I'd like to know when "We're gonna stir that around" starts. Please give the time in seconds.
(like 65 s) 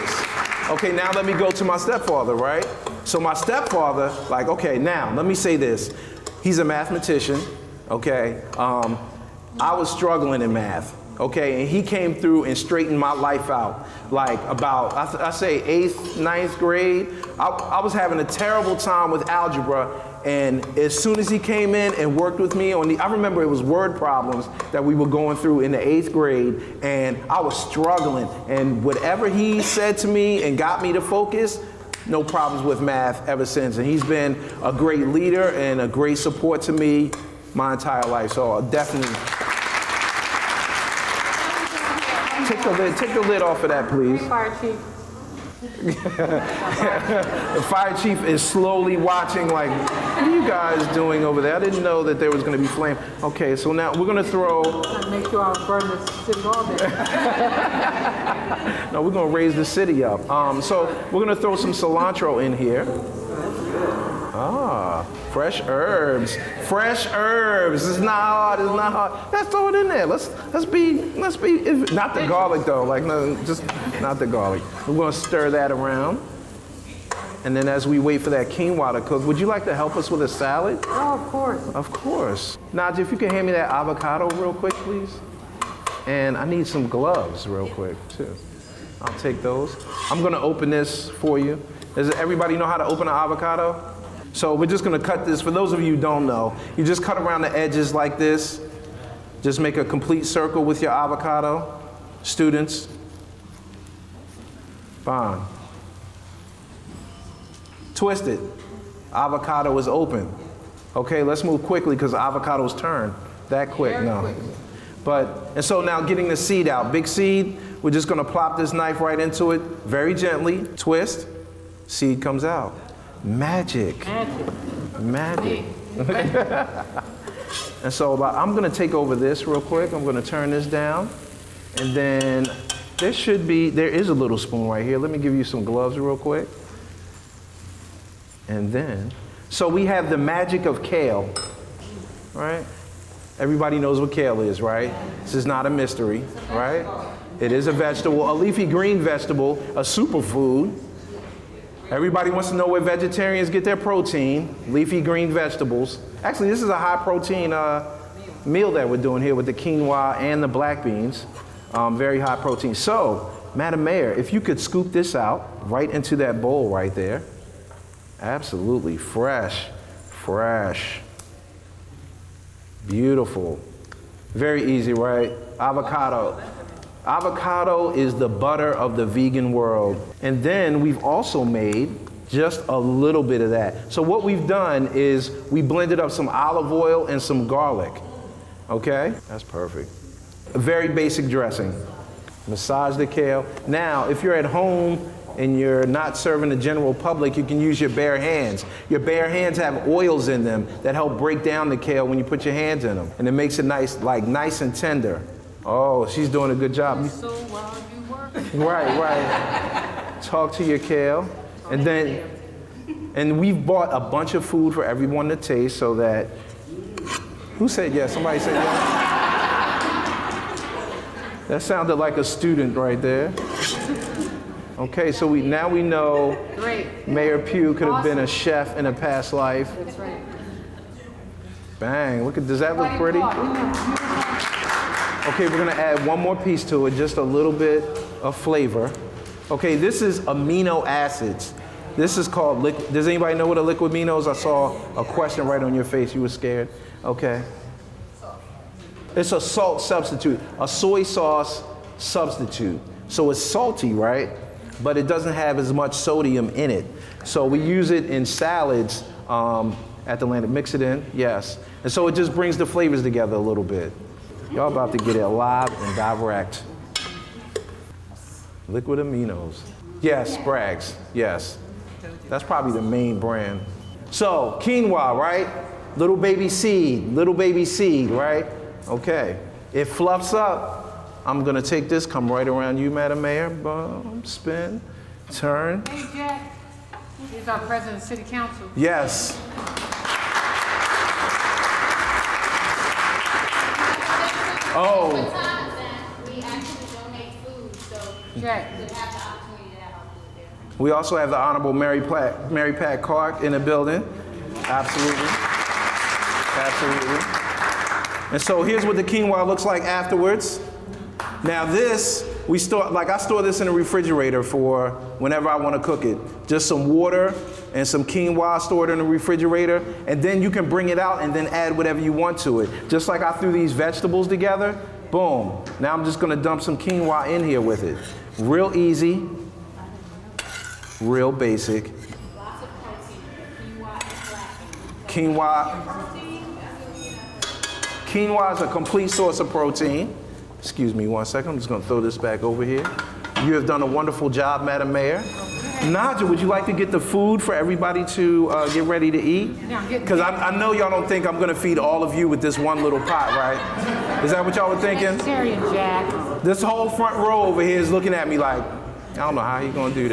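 74 s.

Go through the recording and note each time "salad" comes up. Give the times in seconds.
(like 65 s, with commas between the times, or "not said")
80 s, 258 s.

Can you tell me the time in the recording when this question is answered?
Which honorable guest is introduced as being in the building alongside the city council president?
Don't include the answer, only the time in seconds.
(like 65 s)
302 s.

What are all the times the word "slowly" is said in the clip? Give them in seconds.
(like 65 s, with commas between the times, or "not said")
48 s.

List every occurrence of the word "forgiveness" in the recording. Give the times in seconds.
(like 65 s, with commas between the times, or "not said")
not said.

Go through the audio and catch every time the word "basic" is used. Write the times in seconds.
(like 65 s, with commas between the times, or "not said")
190 s, 331 s.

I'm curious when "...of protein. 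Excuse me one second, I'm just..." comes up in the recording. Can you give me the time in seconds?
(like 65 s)
339 s.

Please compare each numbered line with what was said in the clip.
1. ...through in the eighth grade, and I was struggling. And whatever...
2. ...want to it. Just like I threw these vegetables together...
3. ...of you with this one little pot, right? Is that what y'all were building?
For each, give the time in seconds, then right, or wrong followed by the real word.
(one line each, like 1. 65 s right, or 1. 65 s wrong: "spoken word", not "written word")
1. 25 s right
2. 322 s right
3. 352 s wrong: "thinking", not "building".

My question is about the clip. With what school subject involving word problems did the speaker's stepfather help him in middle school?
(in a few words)
Algebra.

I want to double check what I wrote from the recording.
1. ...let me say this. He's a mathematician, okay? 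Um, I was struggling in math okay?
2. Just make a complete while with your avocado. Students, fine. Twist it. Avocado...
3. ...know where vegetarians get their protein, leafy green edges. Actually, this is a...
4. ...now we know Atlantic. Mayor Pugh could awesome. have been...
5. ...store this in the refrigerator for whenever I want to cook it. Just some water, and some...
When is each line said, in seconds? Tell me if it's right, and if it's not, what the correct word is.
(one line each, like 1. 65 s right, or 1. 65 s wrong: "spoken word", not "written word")
1. 5 s right
2. 99 s wrong: "circle", not "while"
3. 152 s wrong: "vegetables", not "edges"
4. 225 s wrong: "Great", not "Atlantic"
5. 313 s right.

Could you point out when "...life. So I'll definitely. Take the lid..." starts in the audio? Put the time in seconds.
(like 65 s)
38 s.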